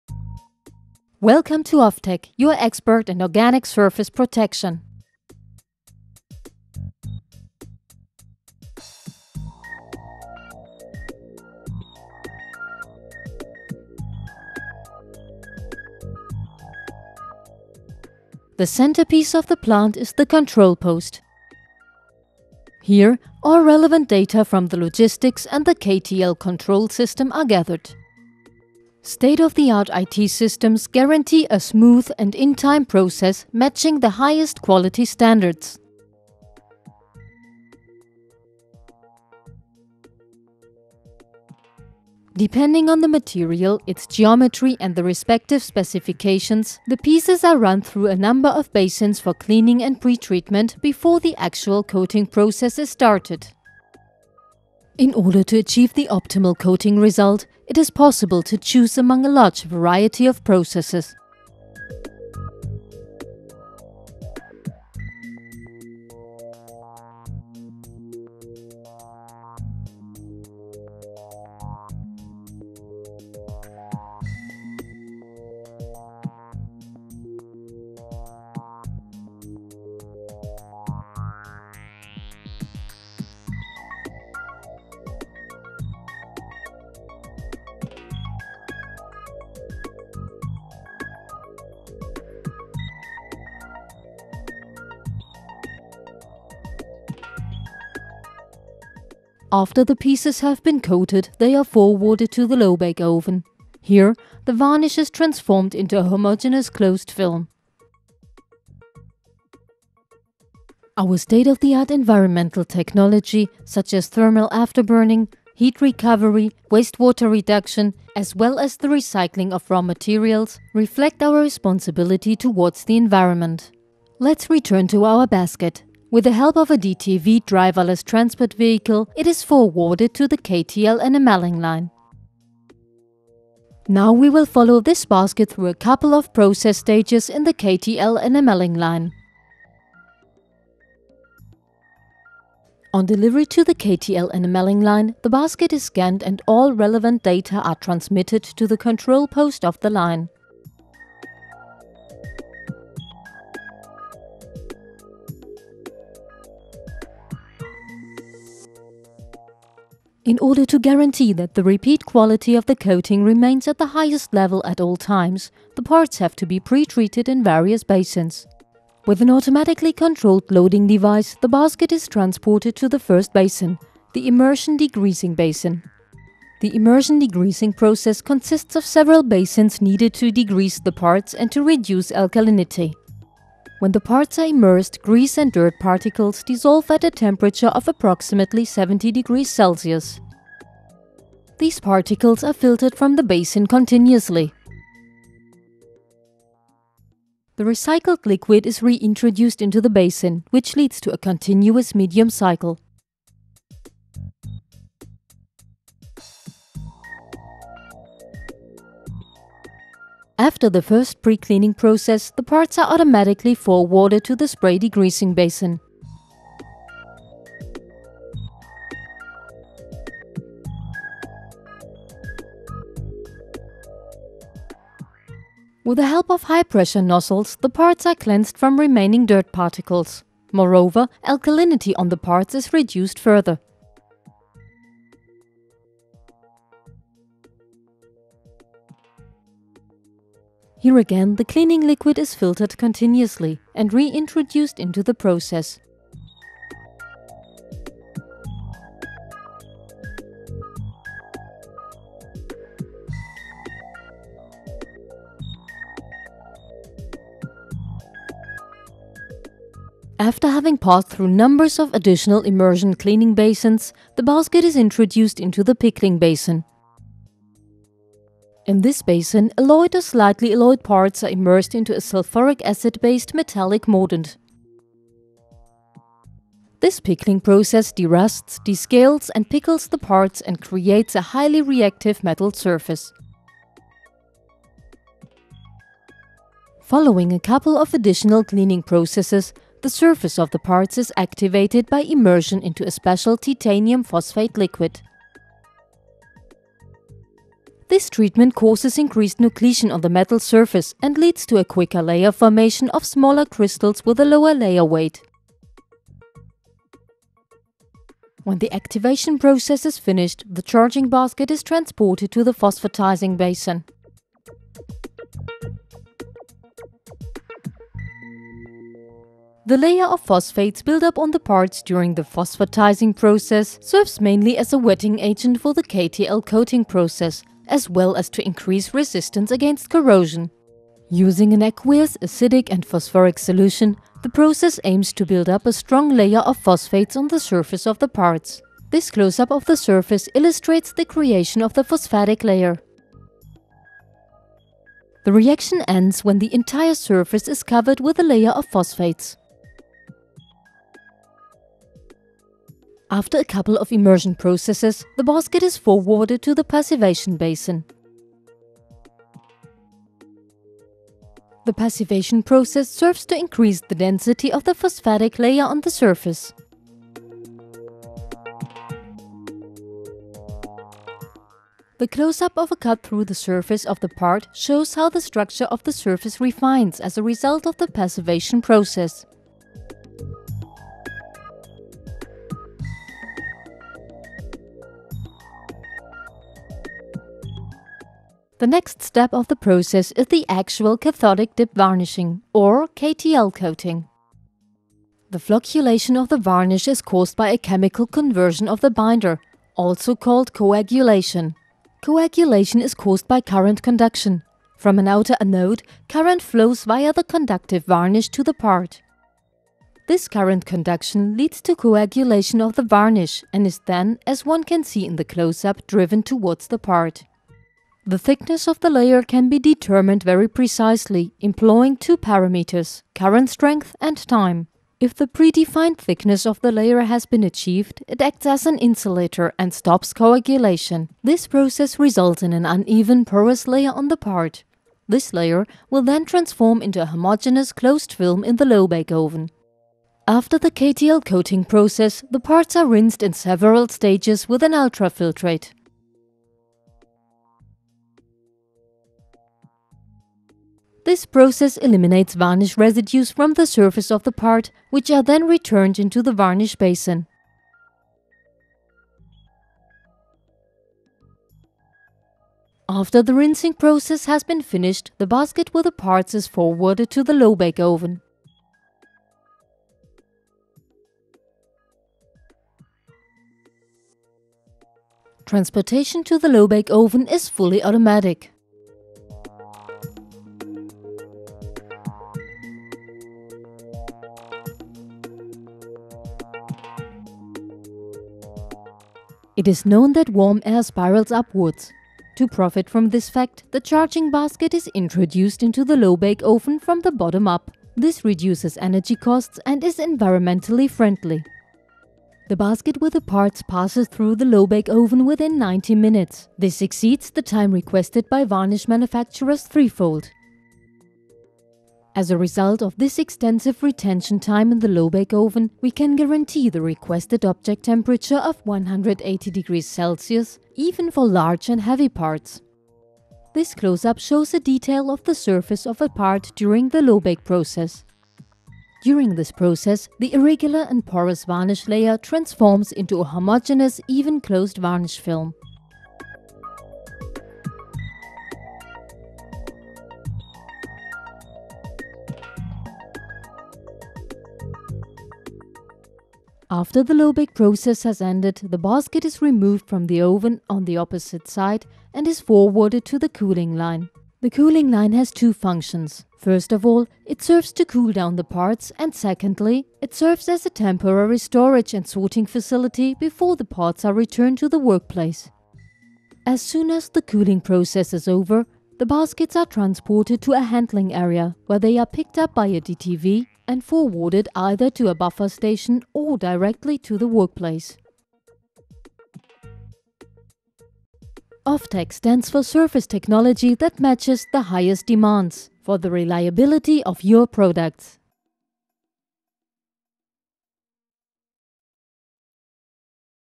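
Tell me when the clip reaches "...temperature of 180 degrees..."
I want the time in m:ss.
8:37.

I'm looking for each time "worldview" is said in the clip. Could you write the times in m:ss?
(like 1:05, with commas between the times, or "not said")
not said.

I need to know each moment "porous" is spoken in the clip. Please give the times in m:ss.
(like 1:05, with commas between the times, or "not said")
7:13, 8:51.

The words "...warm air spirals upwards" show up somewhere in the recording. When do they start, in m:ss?
8:10.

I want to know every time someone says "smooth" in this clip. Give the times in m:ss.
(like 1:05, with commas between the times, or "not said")
0:31.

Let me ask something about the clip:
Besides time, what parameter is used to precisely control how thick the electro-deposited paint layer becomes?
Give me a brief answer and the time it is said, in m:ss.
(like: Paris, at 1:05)
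current strength, at 7:03.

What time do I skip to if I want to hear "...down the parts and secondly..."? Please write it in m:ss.
9:18.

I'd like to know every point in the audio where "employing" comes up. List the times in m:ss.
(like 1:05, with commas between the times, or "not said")
7:01.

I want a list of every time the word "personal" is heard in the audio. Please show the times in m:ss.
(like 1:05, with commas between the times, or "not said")
not said.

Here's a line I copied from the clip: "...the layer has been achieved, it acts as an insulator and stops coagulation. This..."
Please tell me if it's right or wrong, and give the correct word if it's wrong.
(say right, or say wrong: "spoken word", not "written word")
right.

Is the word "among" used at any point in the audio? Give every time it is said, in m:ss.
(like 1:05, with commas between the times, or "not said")
0:58.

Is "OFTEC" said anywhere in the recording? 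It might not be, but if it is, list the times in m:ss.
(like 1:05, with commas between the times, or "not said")
0:01, 9:41.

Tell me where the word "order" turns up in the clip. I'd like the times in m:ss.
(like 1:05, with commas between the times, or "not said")
0:55, 2:40.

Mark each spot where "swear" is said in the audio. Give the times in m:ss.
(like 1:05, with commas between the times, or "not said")
not said.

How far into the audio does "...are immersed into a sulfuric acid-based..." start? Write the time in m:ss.
4:31.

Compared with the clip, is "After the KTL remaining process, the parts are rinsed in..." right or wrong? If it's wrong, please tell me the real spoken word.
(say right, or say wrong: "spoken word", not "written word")
wrong: "coating", not "remaining".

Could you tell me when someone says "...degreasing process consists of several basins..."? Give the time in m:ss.
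2:57.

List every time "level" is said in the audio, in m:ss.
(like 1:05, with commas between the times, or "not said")
2:44.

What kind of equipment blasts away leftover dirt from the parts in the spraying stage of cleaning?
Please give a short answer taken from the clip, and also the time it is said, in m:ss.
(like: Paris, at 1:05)
high-pressure nozzles, at 3:46.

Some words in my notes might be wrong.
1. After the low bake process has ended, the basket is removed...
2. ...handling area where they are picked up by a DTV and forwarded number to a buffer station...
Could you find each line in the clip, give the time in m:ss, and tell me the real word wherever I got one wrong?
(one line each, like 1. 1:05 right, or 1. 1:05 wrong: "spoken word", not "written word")
1. 9:06 right
2. 9:30 wrong: "either", not "number".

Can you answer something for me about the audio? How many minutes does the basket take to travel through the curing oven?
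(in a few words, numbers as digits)
90.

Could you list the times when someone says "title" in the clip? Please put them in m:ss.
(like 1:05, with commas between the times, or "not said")
not said.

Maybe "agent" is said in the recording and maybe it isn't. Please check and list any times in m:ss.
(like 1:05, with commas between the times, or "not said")
5:25.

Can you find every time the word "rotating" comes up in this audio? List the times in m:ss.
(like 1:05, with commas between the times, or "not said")
not said.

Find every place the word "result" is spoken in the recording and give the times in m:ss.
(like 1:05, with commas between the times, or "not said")
0:56, 6:17, 7:11, 8:32.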